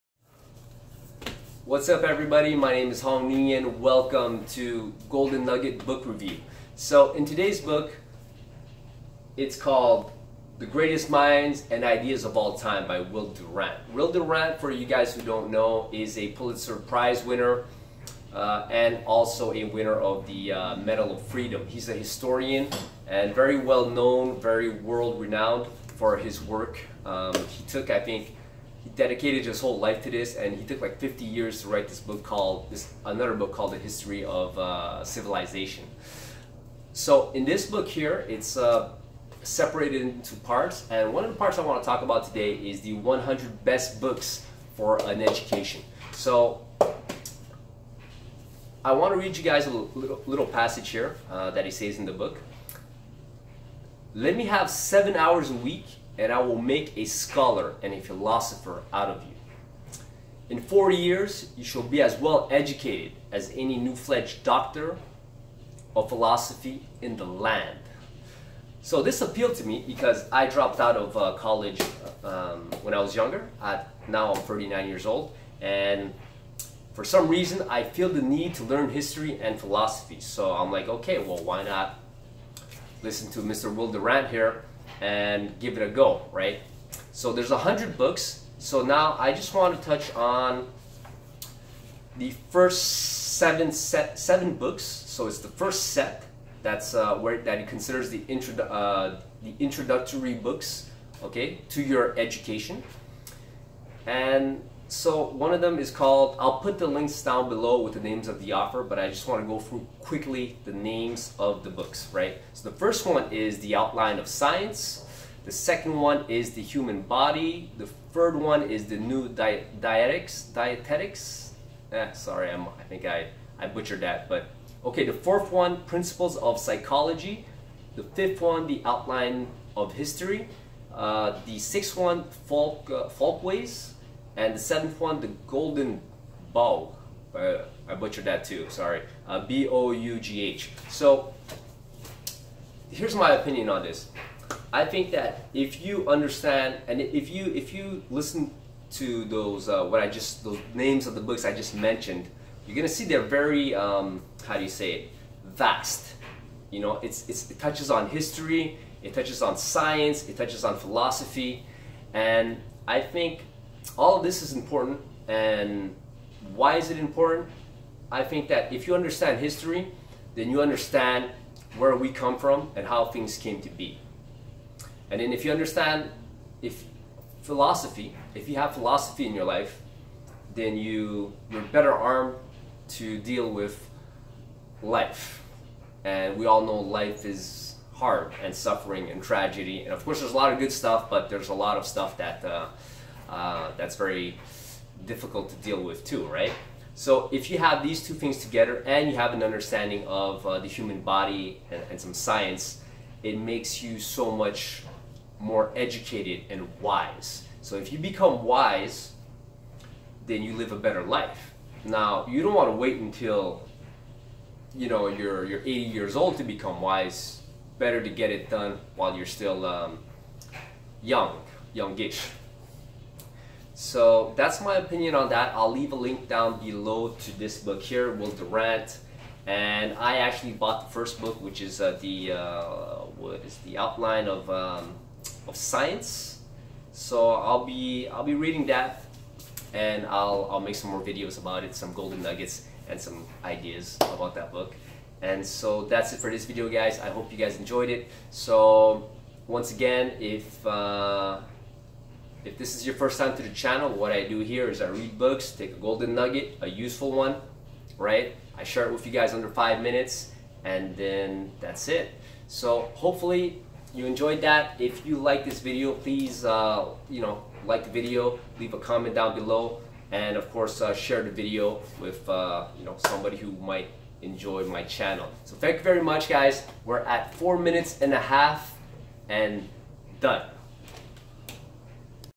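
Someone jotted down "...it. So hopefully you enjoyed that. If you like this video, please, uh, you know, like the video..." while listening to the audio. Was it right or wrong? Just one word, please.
right.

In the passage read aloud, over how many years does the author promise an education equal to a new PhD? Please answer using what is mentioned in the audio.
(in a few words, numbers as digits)
40.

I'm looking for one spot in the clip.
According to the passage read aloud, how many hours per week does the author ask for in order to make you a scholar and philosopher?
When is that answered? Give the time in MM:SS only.
00:54.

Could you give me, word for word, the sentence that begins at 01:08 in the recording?
So this appealed to me because I dropped out of uh, college um, when I was younger.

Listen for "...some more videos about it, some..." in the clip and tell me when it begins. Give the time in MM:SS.
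04:00.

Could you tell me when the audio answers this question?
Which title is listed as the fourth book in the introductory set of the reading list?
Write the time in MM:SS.
02:05.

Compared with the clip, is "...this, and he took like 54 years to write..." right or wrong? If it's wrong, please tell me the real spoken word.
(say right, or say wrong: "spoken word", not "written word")
wrong: "50", not "54".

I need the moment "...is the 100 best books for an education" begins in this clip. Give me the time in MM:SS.
00:42.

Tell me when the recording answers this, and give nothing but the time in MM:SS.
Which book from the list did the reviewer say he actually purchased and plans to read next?
03:53.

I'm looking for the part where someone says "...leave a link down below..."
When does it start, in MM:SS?
03:45.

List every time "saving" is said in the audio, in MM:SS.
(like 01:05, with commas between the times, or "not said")
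not said.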